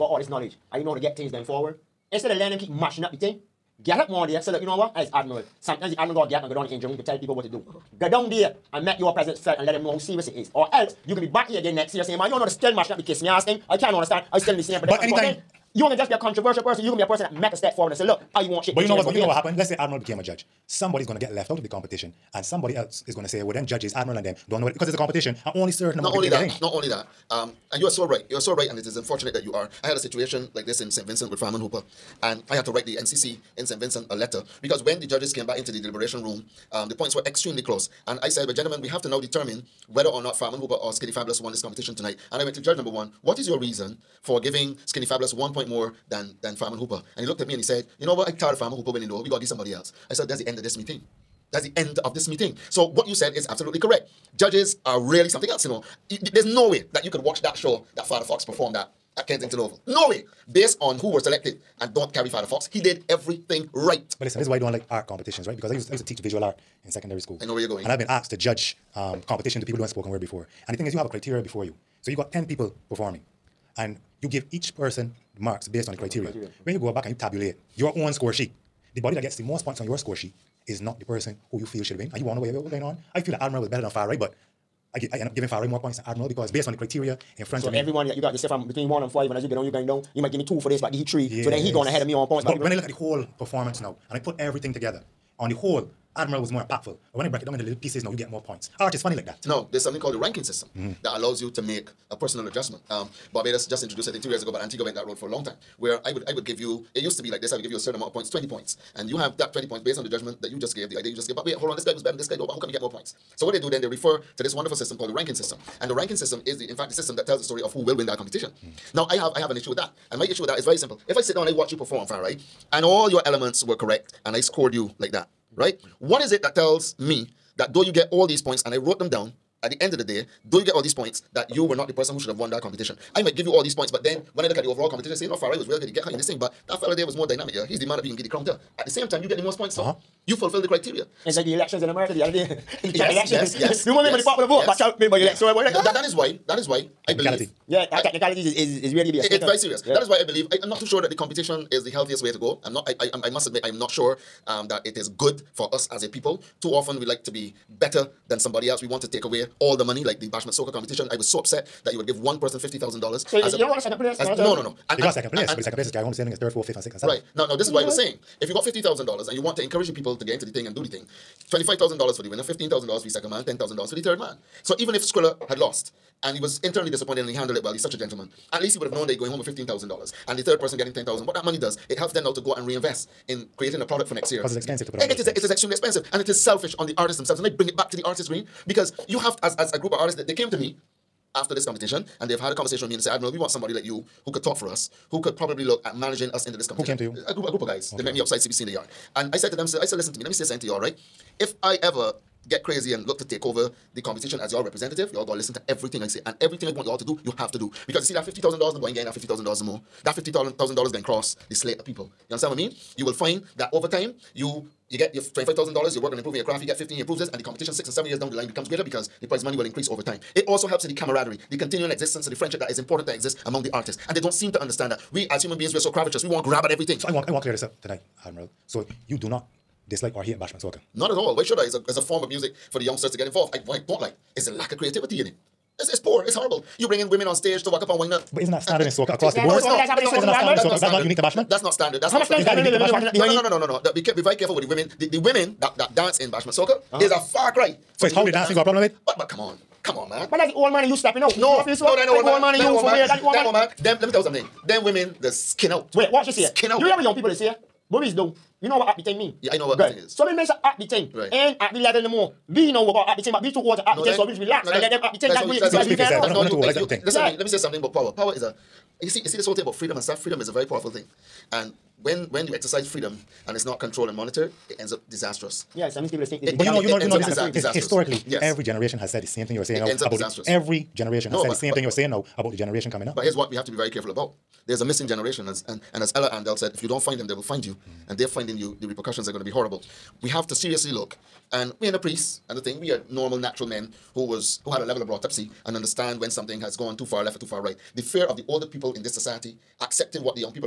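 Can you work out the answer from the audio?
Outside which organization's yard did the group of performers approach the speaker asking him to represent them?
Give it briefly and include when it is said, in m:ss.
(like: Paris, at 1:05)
CBC, at 3:18.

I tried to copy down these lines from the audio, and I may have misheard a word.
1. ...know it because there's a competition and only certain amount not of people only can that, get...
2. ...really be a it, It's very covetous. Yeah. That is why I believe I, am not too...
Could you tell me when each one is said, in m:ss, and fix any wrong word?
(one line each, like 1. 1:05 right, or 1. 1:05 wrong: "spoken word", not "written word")
1. 0:24 right
2. 2:28 wrong: "serious", not "covetous".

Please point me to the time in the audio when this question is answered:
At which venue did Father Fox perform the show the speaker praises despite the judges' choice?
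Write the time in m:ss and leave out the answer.
0:59.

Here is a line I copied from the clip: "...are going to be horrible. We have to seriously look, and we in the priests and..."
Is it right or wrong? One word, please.
right.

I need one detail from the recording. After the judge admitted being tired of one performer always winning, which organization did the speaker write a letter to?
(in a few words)
NCC.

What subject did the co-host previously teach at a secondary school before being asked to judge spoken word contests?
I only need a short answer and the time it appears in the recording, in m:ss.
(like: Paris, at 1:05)
Visual art, at 1:06.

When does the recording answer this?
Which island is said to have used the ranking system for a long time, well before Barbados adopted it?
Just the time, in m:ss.
1:44.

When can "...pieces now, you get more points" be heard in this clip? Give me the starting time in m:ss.
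1:37.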